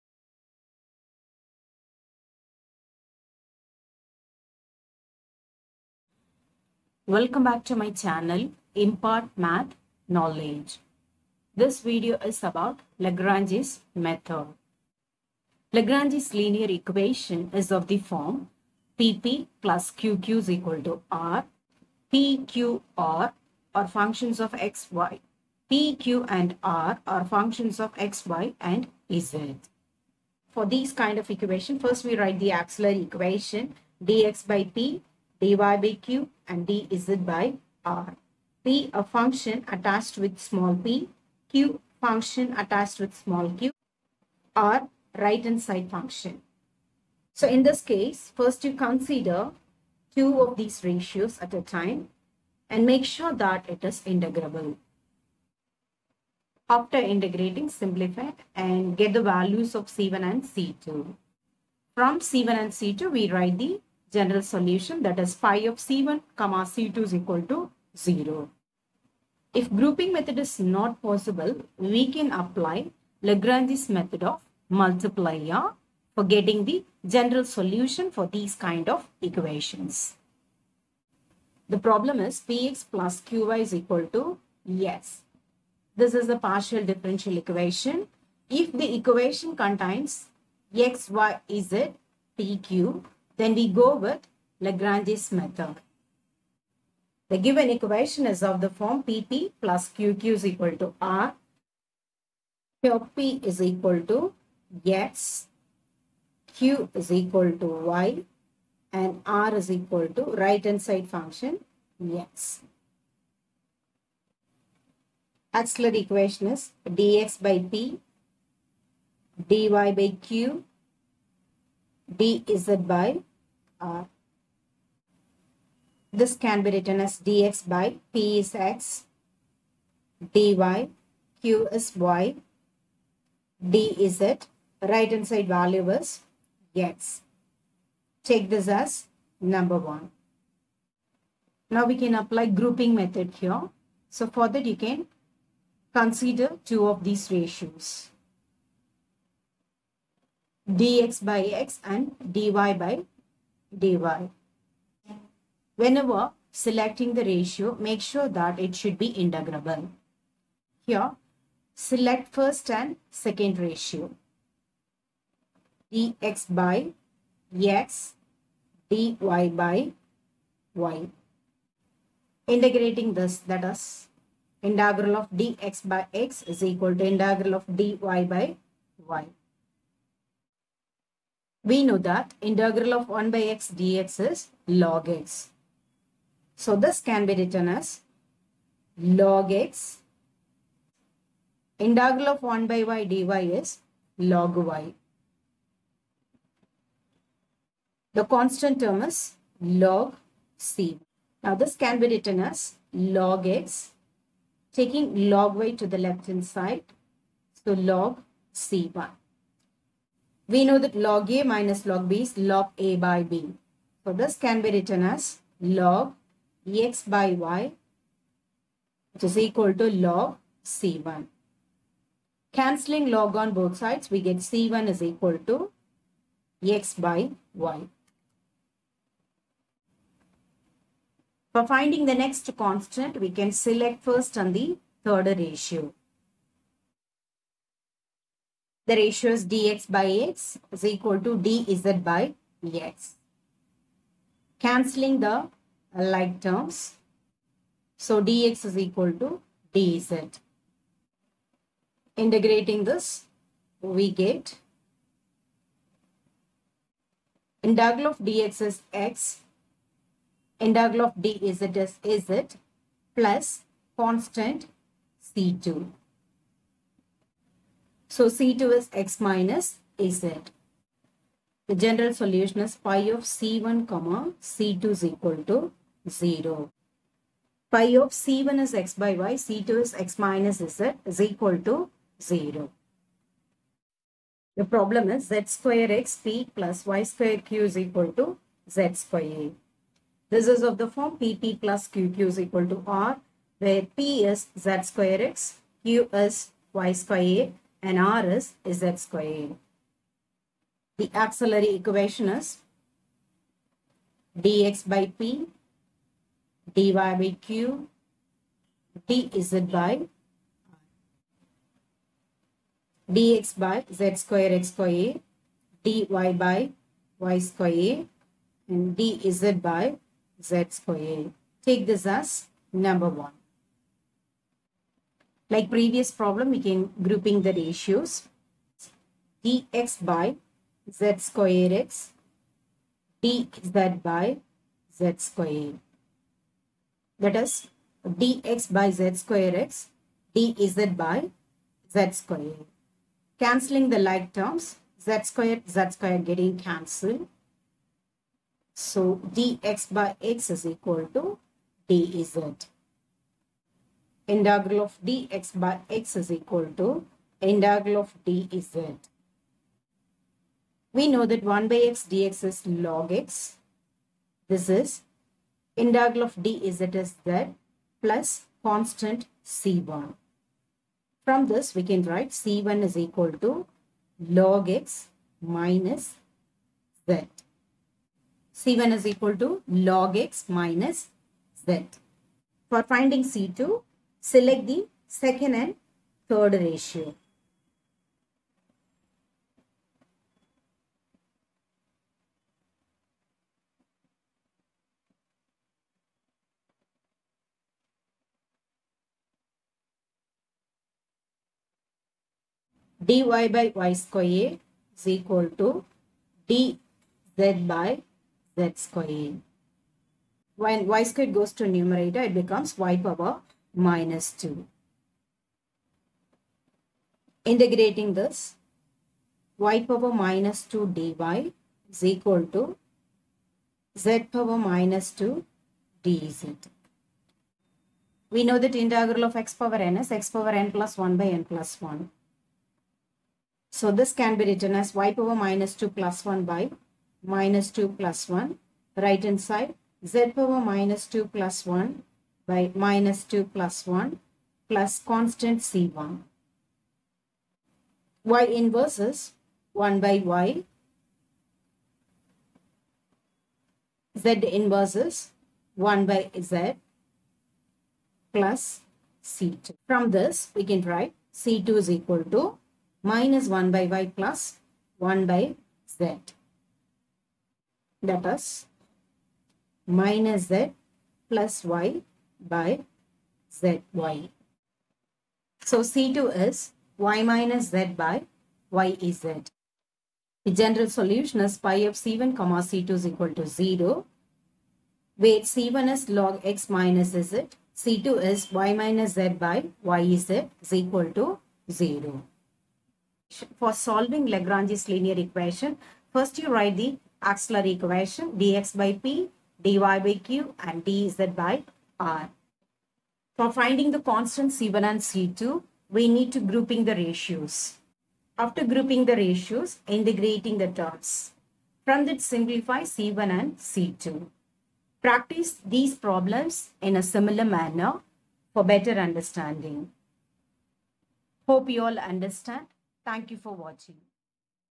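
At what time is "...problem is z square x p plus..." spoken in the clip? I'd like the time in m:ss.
4:44.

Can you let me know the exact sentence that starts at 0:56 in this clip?
After integrating, simplify and get the values of C1 and C2.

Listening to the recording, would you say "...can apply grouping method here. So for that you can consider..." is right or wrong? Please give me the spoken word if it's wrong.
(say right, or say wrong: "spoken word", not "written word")
right.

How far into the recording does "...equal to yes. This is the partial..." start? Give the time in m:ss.
1:23.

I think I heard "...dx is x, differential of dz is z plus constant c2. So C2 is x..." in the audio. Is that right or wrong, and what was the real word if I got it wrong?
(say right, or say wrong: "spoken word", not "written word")
wrong: "integral", not "differential".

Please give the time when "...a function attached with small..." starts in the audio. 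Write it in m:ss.
0:38.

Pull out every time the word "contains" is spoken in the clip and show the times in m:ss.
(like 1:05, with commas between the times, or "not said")
1:29.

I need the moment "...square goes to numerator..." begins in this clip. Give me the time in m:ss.
6:51.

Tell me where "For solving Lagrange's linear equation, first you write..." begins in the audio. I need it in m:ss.
8:13.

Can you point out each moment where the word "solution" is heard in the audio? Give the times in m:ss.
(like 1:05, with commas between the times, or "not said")
1:04, 1:17, 4:32, 8:00.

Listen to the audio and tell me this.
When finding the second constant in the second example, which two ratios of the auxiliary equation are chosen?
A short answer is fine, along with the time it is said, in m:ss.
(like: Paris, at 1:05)
second and third, at 6:25.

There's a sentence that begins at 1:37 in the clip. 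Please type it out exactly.
The given equation is of the form PP plus QQ is equal to R.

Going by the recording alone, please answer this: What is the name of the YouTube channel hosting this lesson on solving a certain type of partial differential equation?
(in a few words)
Impart Math Knowledge.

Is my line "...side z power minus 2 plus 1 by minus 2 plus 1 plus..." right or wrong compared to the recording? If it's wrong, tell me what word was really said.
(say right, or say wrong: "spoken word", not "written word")
right.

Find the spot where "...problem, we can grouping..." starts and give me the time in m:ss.
5:26.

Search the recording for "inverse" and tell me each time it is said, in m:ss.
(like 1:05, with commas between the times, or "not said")
7:28, 7:34.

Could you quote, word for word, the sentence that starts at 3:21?
Now this can be written as log x taking log y to the left hand side.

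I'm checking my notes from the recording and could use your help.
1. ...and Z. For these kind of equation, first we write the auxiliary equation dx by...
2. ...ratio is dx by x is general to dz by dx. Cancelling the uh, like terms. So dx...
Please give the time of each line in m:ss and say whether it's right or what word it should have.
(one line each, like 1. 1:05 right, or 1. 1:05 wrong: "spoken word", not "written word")
1. 0:28 right
2. 3:58 wrong: "equal", not "general".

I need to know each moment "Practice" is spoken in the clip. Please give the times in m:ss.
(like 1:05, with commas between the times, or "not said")
8:35.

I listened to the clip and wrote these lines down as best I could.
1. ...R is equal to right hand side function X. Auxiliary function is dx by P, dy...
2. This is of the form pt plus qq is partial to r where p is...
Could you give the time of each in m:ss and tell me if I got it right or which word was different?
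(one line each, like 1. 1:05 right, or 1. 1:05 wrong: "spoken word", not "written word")
1. 1:49 wrong: "equation", not "function"
2. 4:50 wrong: "equal", not "partial".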